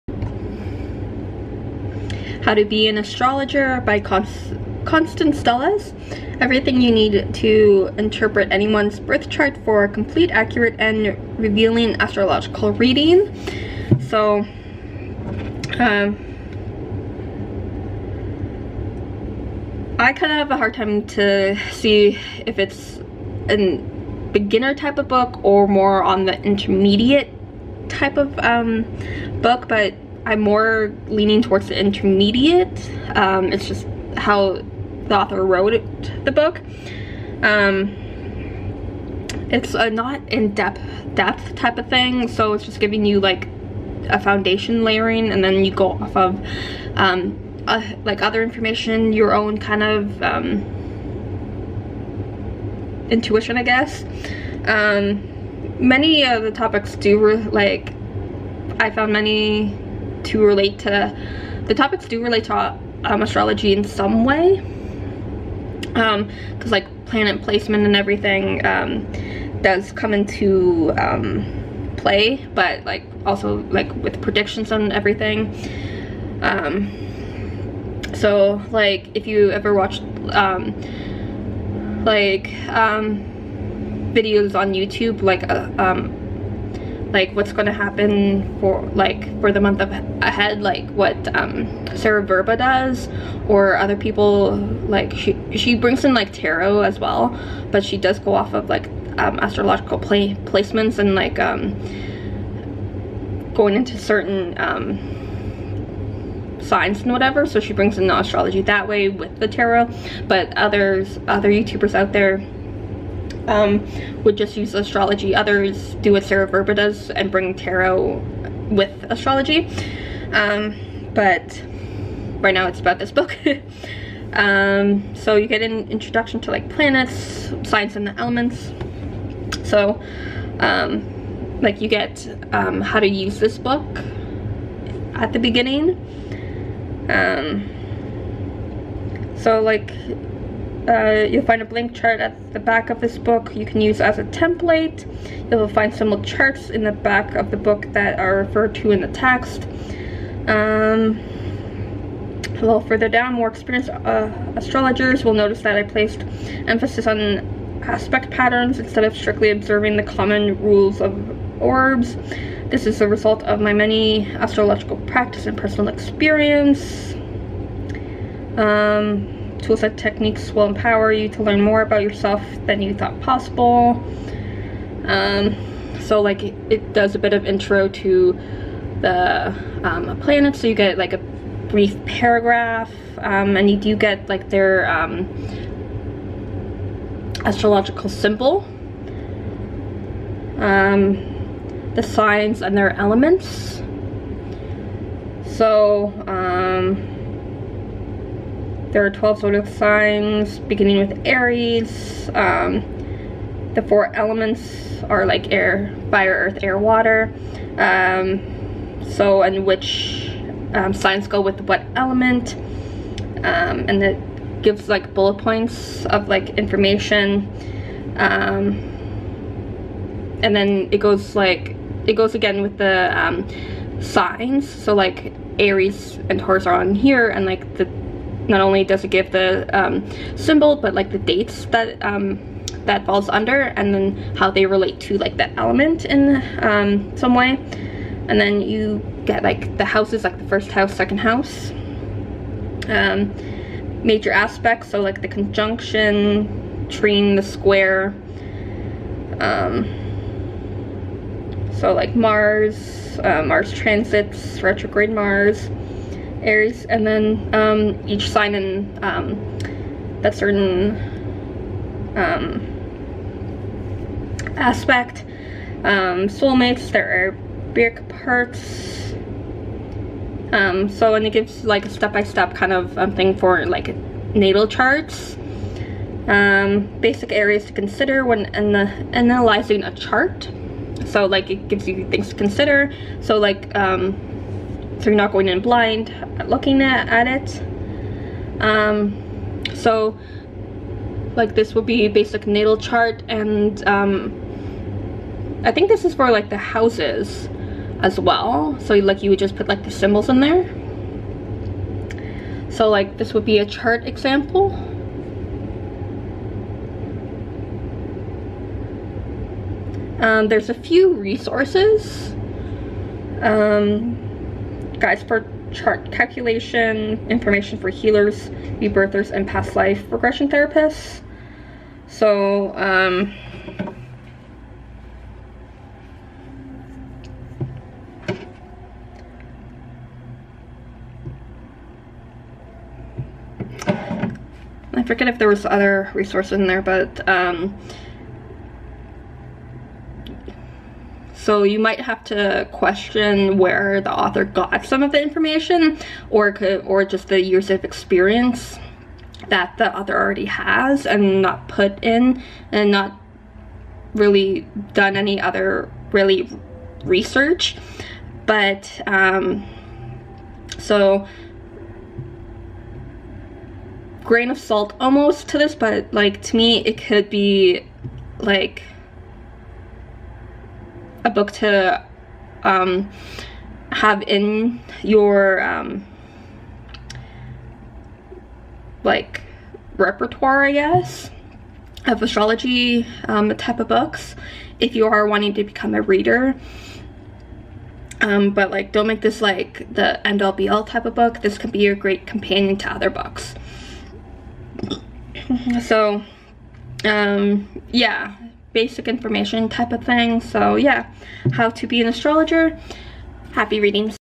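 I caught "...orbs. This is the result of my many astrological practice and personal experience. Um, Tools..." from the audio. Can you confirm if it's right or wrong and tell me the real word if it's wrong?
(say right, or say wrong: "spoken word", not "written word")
right.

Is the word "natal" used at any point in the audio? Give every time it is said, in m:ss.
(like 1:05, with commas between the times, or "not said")
4:34, 4:52.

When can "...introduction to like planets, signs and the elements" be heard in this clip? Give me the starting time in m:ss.
2:05.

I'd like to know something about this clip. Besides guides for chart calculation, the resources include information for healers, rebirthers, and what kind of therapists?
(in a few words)
Past life regression.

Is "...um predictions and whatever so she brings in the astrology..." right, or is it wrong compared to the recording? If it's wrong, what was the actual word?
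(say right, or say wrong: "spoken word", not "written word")
wrong: "signs", not "predictions".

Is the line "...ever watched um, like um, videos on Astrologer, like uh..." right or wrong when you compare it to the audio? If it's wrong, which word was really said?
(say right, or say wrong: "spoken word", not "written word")
wrong: "YouTube", not "Astrologer".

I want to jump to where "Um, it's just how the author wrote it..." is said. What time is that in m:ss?
0:33.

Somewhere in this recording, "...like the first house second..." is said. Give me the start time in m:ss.
4:00.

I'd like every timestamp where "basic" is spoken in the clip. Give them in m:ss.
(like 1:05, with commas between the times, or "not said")
4:36, 4:52, 6:38.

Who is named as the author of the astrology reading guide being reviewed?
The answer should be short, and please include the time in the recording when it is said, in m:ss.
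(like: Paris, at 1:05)
Constance Stellas, at 0:04.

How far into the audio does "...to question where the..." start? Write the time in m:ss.
5:42.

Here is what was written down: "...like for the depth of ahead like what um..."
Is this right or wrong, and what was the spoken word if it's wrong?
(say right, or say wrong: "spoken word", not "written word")
wrong: "month", not "depth".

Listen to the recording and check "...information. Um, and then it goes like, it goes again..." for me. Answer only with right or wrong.
right.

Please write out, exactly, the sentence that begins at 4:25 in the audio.
Um, soulmates, there are big parts.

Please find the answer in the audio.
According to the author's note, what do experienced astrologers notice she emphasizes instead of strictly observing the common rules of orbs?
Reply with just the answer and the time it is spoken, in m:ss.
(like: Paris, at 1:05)
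Aspect patterns, at 2:37.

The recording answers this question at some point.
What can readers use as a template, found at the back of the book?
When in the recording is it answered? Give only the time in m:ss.
2:21.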